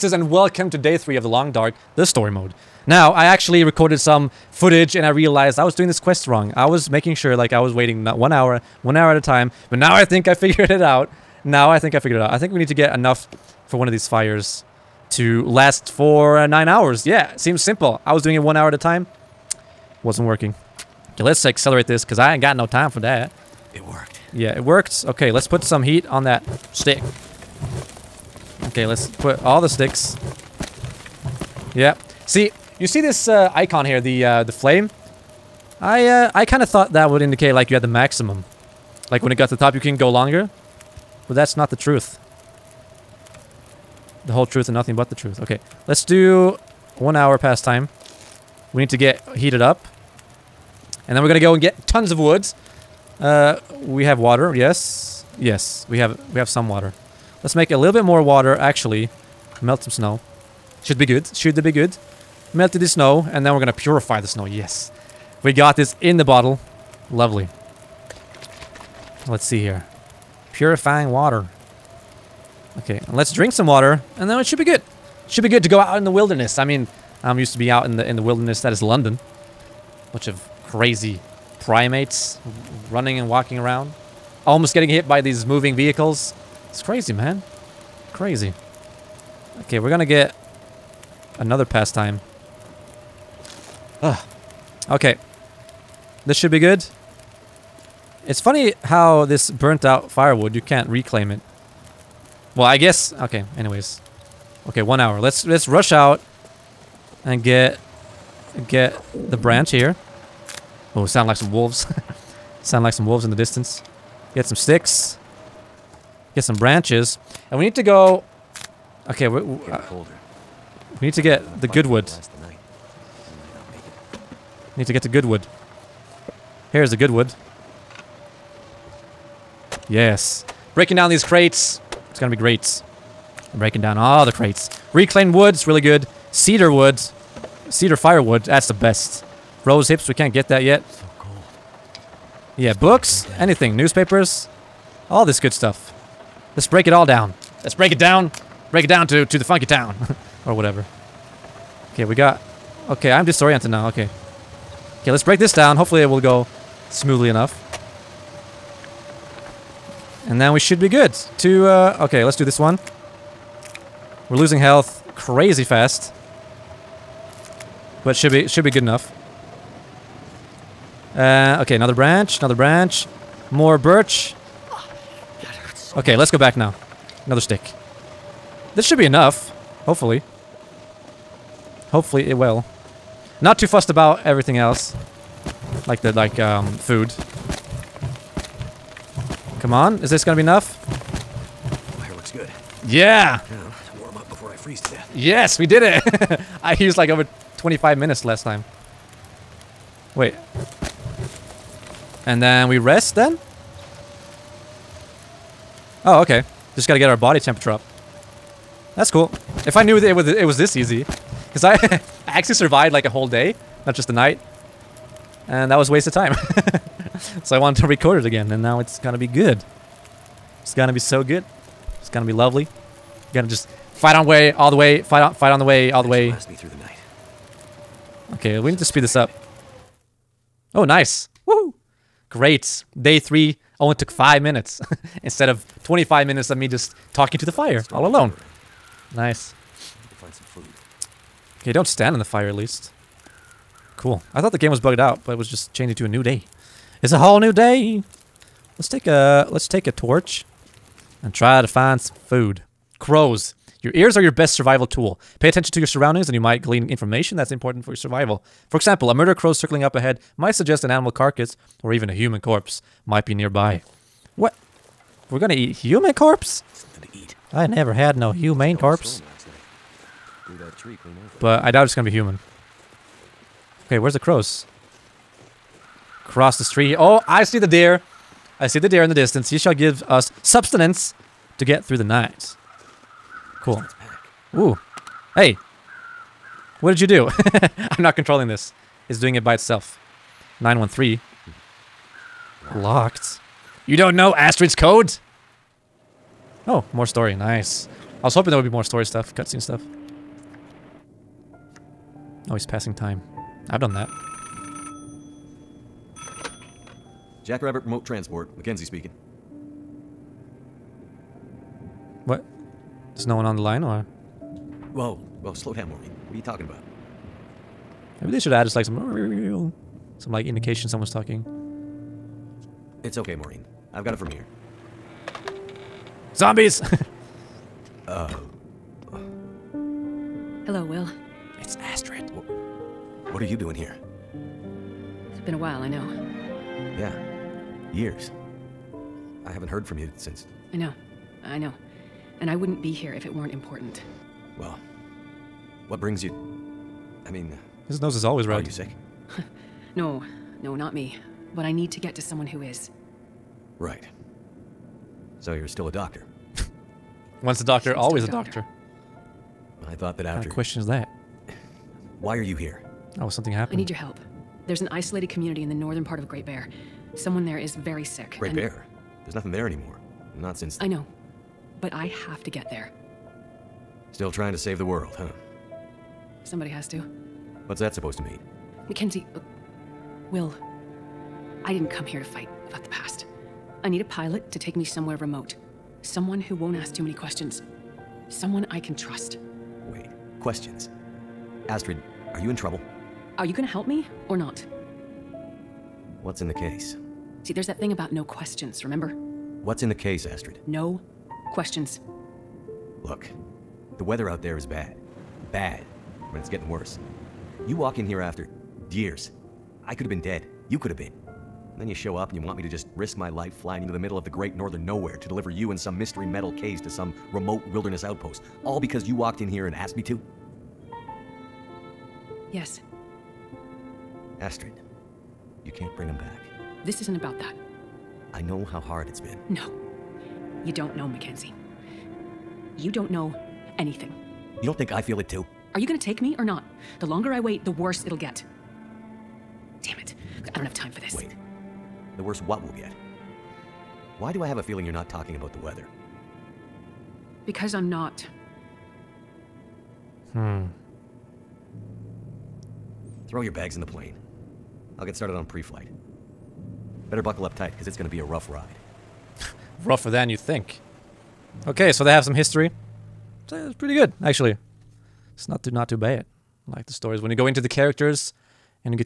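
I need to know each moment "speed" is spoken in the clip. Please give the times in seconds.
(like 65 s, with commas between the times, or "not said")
228 s.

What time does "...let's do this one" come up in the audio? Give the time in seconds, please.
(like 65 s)
162 s.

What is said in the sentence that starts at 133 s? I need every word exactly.
I'm breaking down all the crates.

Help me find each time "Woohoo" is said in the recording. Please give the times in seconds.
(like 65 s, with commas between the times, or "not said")
231 s.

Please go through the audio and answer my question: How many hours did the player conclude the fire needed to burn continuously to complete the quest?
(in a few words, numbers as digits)
9.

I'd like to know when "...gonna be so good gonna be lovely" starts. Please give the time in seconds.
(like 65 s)
220 s.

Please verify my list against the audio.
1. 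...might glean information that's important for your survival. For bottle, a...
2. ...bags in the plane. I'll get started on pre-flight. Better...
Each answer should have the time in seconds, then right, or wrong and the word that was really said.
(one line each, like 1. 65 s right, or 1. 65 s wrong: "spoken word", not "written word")
1. 256 s wrong: "example", not "bottle"
2. 453 s right.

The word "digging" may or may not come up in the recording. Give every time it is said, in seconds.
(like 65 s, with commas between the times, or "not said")
not said.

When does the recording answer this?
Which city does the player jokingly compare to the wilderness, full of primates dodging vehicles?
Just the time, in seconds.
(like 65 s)
78 s.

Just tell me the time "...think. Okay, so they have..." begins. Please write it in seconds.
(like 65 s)
460 s.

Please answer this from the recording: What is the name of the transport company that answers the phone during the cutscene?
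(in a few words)
Jackrabbit Remote Transport.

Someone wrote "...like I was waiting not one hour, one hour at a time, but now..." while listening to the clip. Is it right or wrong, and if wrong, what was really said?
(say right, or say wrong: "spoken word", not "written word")
right.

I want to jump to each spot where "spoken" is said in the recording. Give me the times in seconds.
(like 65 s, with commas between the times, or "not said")
not said.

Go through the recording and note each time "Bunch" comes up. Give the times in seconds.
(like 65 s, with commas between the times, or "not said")
80 s.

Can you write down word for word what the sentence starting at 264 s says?
What we're gonna eat human corpse?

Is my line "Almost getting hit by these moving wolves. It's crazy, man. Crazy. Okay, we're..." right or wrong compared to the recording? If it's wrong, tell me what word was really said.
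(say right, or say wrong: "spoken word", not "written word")
wrong: "vehicles", not "wolves".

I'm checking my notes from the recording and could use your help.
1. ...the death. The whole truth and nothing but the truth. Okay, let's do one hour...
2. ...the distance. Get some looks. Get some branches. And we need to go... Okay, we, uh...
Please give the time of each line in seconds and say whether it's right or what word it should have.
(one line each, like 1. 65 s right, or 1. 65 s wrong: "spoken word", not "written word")
1. 41 s wrong: "truth", not "death"
2. 113 s wrong: "sticks", not "looks".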